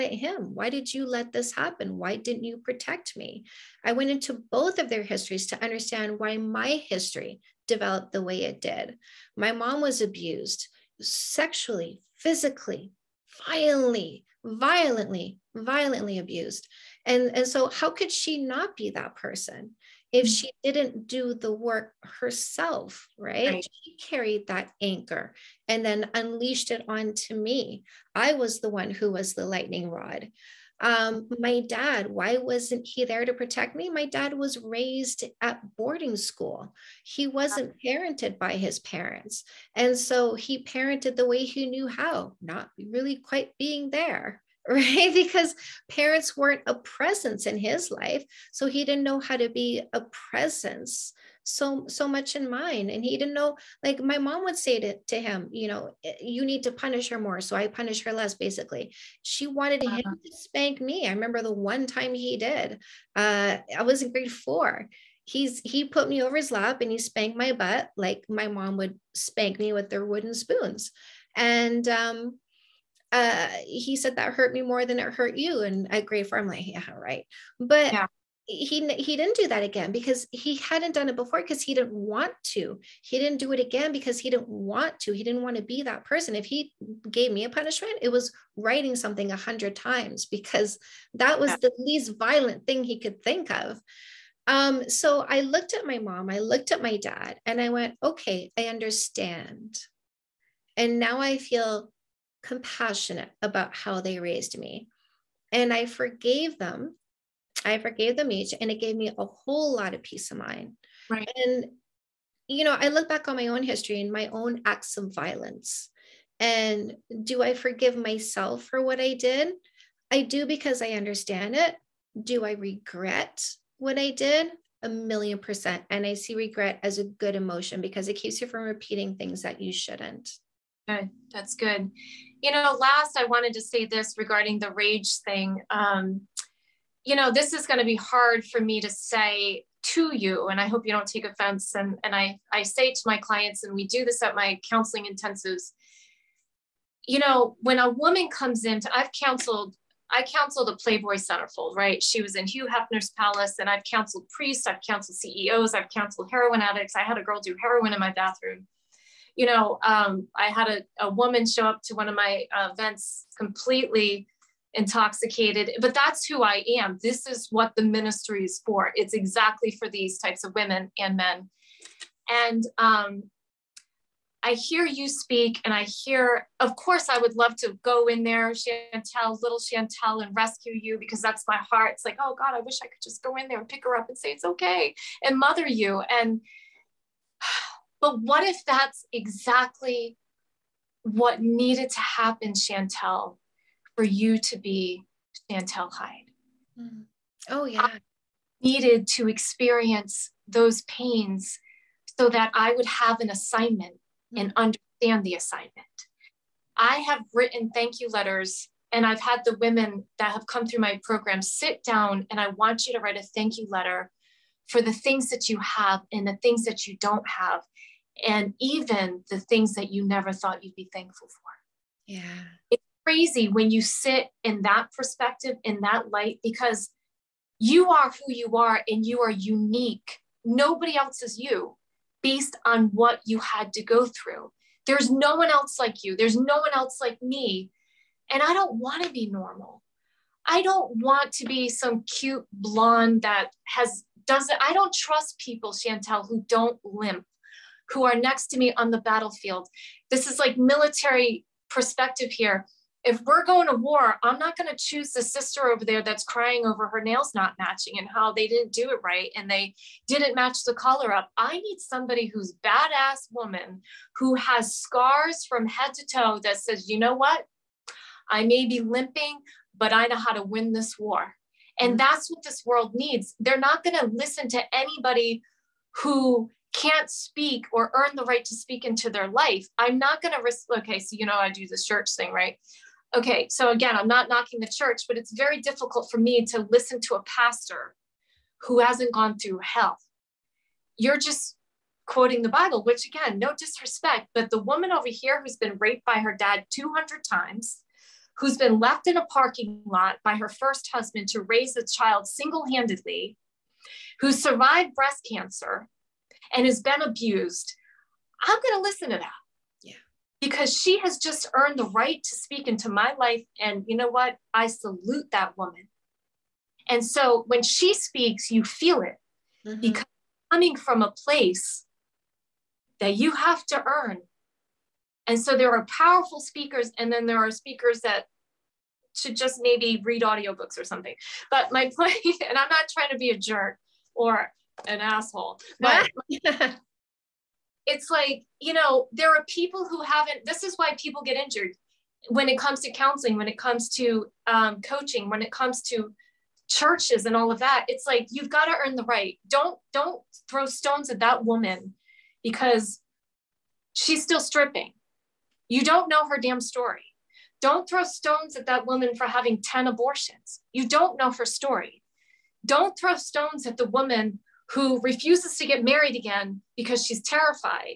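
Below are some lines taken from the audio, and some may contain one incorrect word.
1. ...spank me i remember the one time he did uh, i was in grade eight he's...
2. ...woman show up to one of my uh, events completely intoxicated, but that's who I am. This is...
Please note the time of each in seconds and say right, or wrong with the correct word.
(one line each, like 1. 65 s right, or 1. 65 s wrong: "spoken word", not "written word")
1. 60 s wrong: "four", not "eight"
2. 161 s right.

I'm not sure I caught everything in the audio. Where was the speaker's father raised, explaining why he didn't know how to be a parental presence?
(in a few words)
Boarding school.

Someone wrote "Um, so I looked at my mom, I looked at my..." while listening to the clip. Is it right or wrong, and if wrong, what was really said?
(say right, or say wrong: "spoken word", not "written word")
right.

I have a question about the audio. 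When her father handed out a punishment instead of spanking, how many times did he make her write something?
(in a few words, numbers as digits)
100.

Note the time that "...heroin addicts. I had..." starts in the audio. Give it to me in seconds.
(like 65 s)
156 s.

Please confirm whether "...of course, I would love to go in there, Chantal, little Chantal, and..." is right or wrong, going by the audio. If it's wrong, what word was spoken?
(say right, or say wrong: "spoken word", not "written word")
right.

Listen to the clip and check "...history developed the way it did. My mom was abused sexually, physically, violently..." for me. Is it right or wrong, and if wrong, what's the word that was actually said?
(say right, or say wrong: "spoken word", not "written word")
right.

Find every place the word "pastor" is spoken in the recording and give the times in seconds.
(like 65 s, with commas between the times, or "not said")
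287 s.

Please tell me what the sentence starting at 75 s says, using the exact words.
And at grade four, I'm like, yeah, right.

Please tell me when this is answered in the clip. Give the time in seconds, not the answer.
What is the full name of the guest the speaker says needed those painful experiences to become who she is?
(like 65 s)
195 s.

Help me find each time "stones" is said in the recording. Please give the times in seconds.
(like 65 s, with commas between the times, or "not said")
350 s, 358 s, 363 s.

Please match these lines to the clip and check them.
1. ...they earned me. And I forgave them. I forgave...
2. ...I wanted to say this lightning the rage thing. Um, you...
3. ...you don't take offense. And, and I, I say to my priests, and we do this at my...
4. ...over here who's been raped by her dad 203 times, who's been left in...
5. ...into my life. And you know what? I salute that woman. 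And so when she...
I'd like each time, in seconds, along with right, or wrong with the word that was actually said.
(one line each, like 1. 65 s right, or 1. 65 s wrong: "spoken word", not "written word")
1. 104 s wrong: "raised", not "earned"
2. 133 s wrong: "regarding", not "lightning"
3. 140 s wrong: "clients", not "priests"
4. 294 s wrong: "200", not "203"
5. 312 s right.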